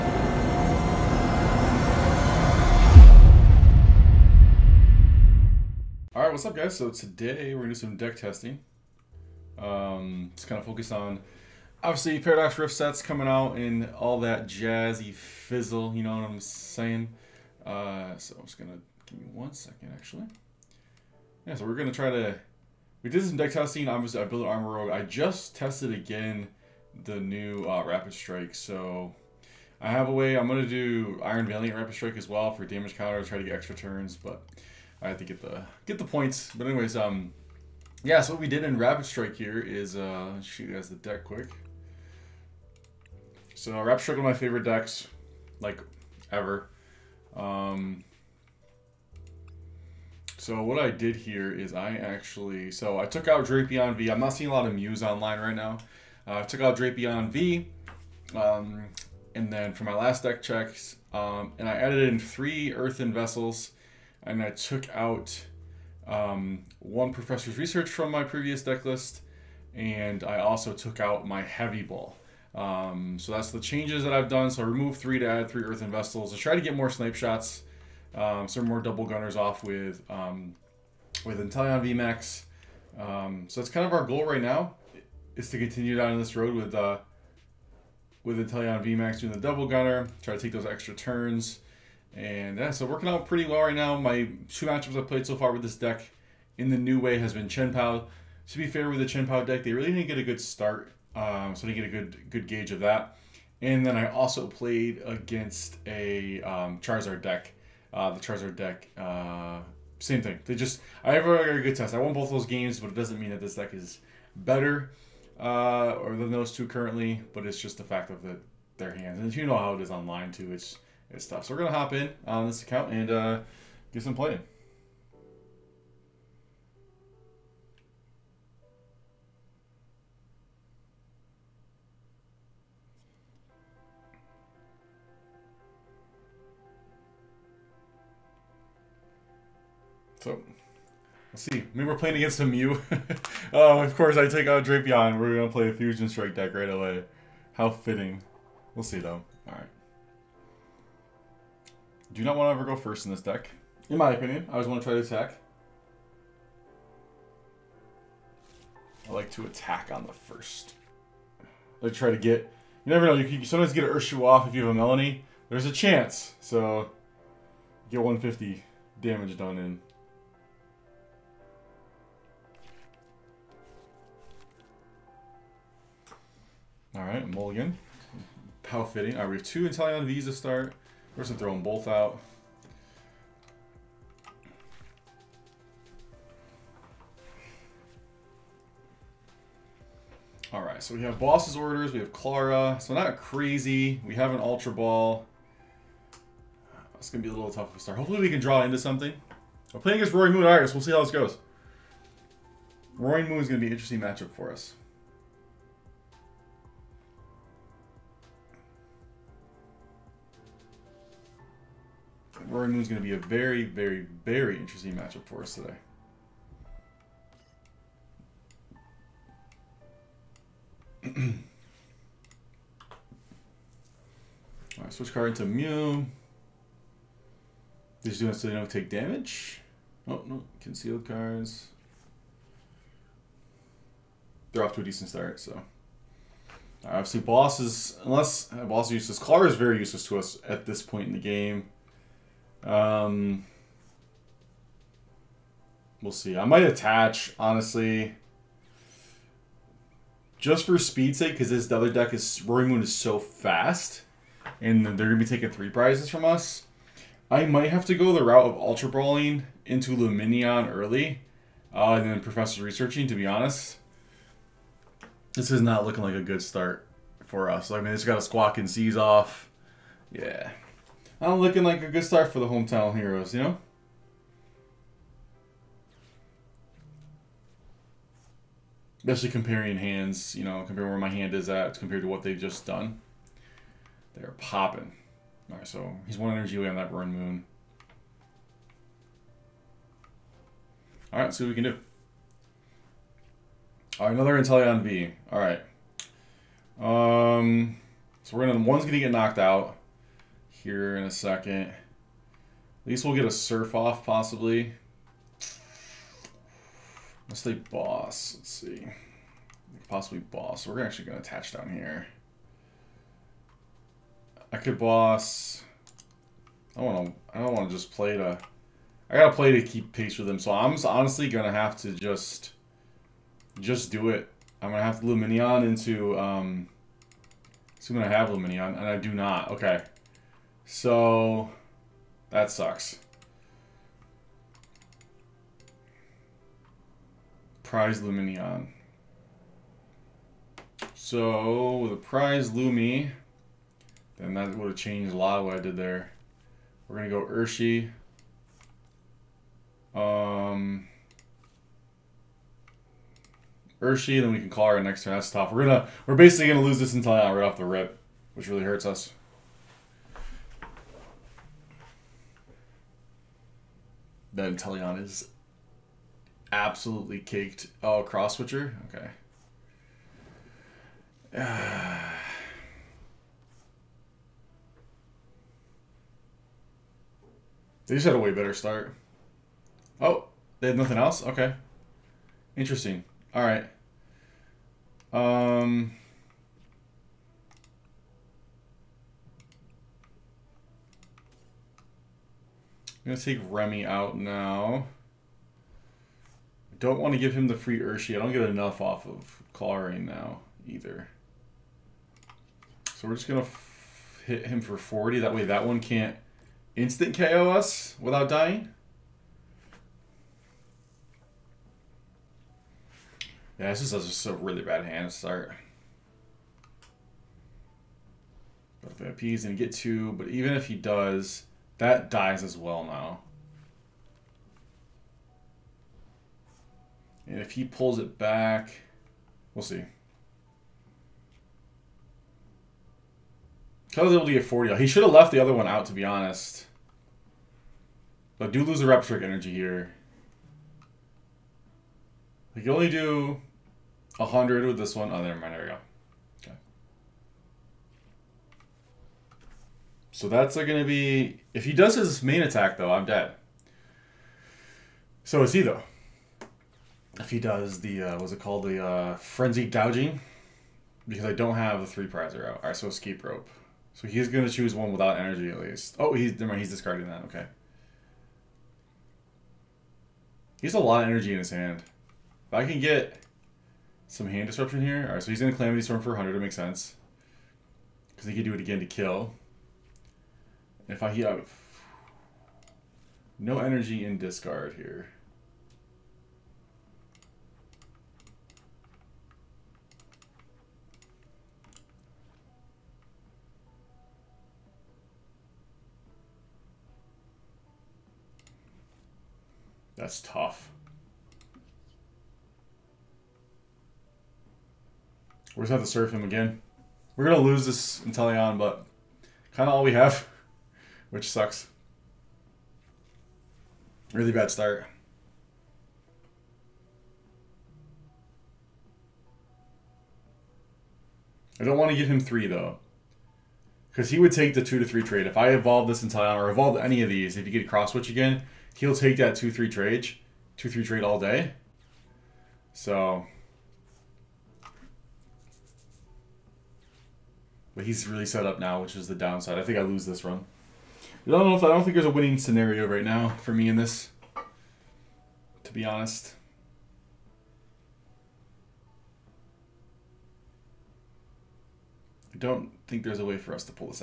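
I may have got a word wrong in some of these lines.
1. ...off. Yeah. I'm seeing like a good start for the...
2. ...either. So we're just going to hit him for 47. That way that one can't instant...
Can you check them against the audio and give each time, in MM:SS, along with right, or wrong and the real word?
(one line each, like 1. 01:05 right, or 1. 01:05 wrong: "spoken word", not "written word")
1. 04:28 wrong: "looking", not "seeing"
2. 06:40 wrong: "40", not "47".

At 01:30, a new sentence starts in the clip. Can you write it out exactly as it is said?
Try to take those extra turns.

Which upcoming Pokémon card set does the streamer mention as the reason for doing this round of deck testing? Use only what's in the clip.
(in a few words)
Paradox Rift.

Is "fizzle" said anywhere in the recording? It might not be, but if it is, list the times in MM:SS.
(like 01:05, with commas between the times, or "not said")
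00:15.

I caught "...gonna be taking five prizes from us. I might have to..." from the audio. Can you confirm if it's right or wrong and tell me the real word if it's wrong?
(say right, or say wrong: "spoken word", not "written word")
wrong: "three", not "five".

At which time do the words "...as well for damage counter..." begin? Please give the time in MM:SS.
00:32.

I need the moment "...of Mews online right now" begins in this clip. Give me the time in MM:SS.
00:54.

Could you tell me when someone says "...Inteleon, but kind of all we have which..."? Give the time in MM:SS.
08:27.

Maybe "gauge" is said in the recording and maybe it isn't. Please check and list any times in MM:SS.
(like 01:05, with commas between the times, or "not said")
01:42.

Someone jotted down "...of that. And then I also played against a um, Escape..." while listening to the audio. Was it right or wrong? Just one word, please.
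wrong.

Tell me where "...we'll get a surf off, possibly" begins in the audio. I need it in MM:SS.
05:03.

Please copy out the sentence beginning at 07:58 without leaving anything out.
Because he could do it again to kill.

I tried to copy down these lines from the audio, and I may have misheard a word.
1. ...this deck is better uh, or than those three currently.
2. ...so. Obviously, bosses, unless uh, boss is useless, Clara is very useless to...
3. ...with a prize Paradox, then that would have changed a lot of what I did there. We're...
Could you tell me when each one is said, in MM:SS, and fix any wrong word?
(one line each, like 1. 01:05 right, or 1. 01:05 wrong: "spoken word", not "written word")
1. 01:53 wrong: "two", not "three"
2. 03:55 right
3. 05:41 wrong: "Lumi", not "Paradox".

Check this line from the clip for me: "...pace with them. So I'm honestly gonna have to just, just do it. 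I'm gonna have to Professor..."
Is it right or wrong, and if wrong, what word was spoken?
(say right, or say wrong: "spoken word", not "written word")
wrong: "Lumineon", not "Professor".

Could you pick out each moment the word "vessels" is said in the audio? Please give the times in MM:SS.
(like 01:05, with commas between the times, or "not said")
01:03, 01:15.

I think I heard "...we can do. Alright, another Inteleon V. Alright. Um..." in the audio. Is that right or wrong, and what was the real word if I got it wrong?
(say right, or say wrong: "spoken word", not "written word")
right.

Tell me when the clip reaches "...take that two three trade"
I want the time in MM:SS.
08:48.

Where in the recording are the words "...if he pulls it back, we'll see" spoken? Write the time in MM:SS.
07:07.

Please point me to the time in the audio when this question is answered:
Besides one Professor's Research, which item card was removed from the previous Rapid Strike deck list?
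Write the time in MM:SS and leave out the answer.
01:11.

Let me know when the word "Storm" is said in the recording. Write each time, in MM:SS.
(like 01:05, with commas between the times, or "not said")
07:55.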